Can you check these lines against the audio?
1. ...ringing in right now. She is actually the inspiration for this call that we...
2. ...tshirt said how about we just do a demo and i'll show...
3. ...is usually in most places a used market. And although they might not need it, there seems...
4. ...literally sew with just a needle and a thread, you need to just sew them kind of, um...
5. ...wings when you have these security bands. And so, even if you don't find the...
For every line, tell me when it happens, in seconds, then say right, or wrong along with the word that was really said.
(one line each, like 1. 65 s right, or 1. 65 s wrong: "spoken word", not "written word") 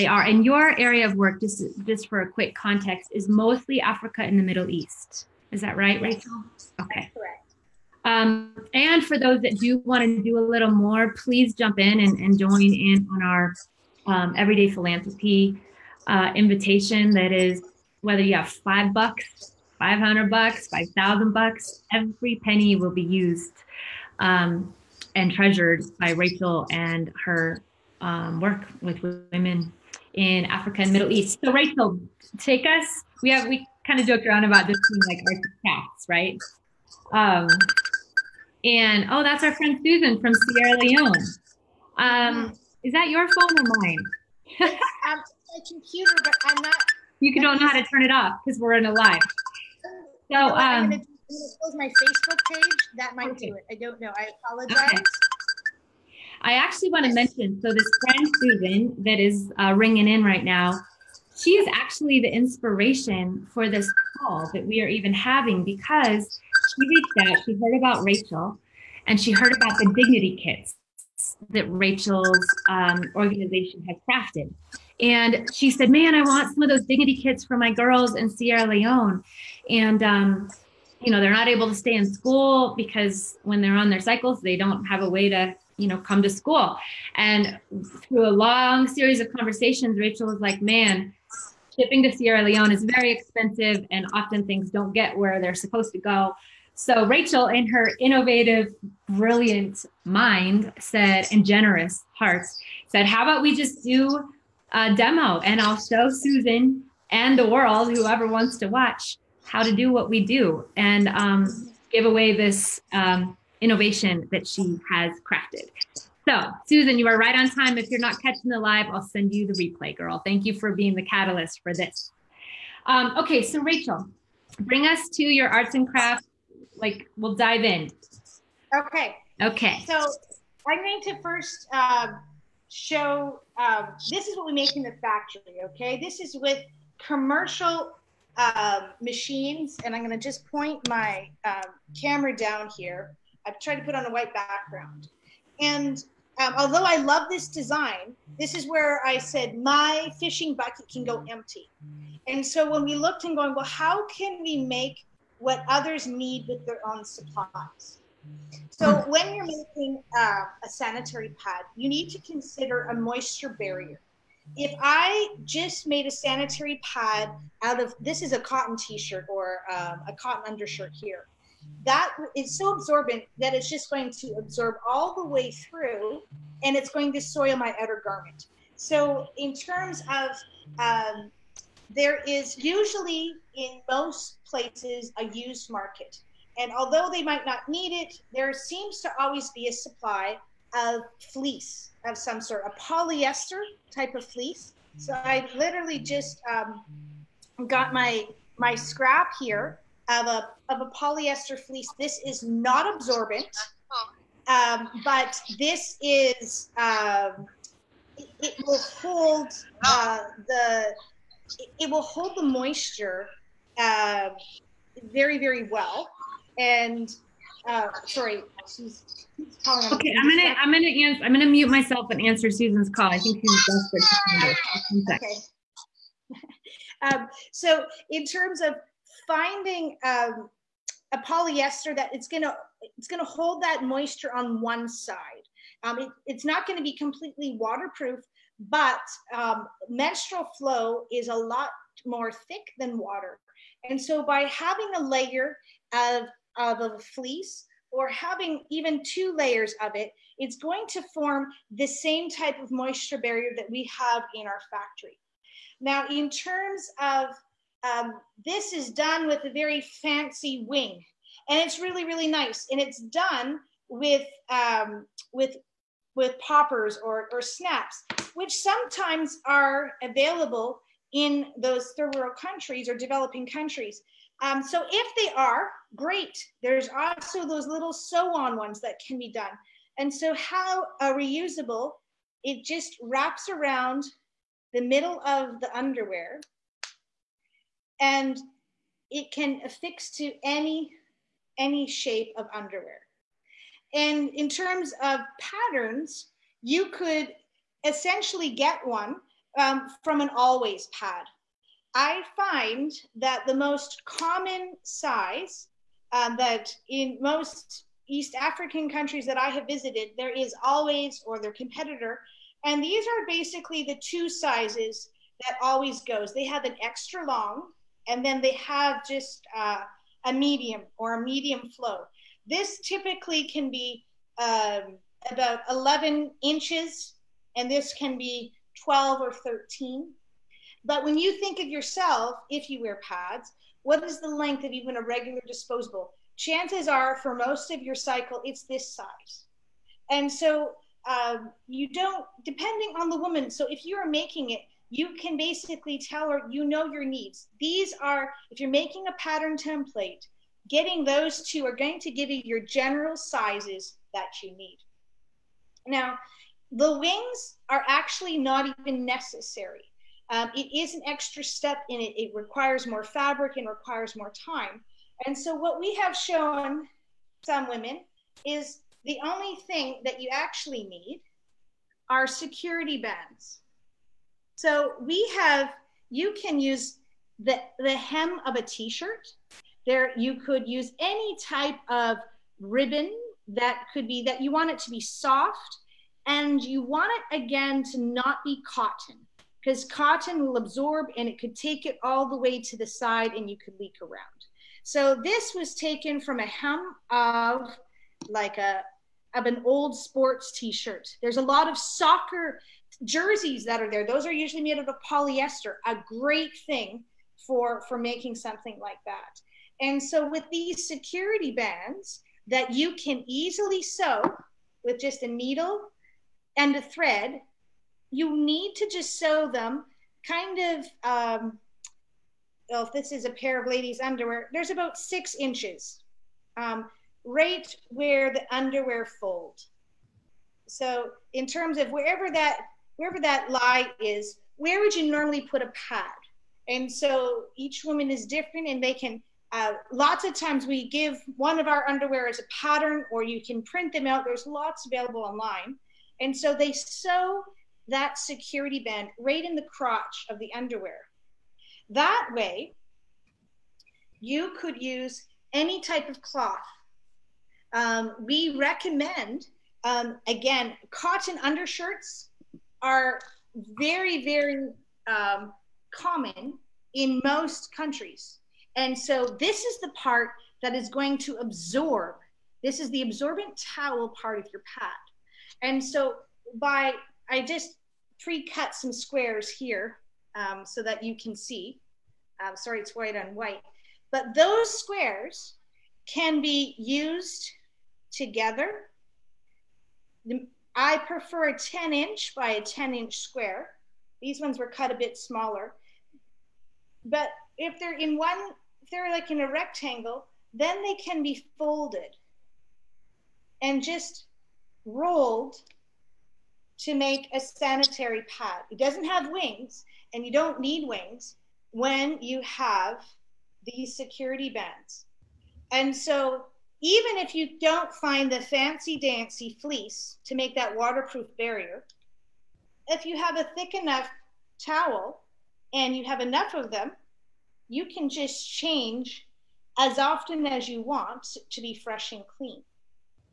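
1. 59 s right
2. 102 s wrong: "heart", not "tshirt"
3. 182 s right
4. 413 s wrong: "easily", not "literally"
5. 510 s right.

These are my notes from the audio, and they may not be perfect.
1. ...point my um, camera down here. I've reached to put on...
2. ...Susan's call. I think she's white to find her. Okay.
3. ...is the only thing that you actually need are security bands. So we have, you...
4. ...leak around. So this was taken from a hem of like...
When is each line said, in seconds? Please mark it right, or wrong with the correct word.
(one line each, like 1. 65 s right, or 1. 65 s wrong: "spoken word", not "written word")
1. 140 s wrong: "tried", not "reached"
2. 222 s wrong: "desperate", not "white"
3. 368 s right
4. 393 s right.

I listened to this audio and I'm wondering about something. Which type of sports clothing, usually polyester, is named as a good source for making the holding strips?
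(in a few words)
soccer jerseys.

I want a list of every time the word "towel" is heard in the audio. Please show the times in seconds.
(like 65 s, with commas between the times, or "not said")
473 s, 524 s.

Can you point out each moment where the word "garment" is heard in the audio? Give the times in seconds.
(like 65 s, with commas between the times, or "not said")
178 s.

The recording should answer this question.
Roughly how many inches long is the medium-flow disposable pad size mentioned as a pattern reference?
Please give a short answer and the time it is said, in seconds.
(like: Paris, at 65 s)
11 inches, at 325 s.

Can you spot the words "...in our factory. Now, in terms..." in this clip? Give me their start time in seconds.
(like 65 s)
254 s.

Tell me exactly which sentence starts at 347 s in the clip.
These are, if you're making a pattern template, getting those two are going to give you your general sizes that you need.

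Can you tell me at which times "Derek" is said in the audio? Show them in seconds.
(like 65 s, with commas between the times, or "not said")
not said.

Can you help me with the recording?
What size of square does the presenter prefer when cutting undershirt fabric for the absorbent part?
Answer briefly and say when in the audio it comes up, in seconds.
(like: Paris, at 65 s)
10 inch by 10 inch, at 491 s.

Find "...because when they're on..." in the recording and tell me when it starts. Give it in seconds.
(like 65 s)
82 s.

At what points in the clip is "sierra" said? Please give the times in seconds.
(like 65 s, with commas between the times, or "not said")
40 s, 78 s, 92 s.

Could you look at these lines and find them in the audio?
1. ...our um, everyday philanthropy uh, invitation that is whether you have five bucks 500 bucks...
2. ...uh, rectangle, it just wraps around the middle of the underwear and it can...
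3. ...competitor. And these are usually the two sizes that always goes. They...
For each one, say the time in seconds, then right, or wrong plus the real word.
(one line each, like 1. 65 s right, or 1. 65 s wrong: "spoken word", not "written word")
1. 13 s right
2. 281 s wrong: "reusable", not "rectangle"
3. 311 s wrong: "basically", not "usually".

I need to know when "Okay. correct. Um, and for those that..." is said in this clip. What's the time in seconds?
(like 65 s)
6 s.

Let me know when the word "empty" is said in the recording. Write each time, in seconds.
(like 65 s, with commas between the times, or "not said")
151 s.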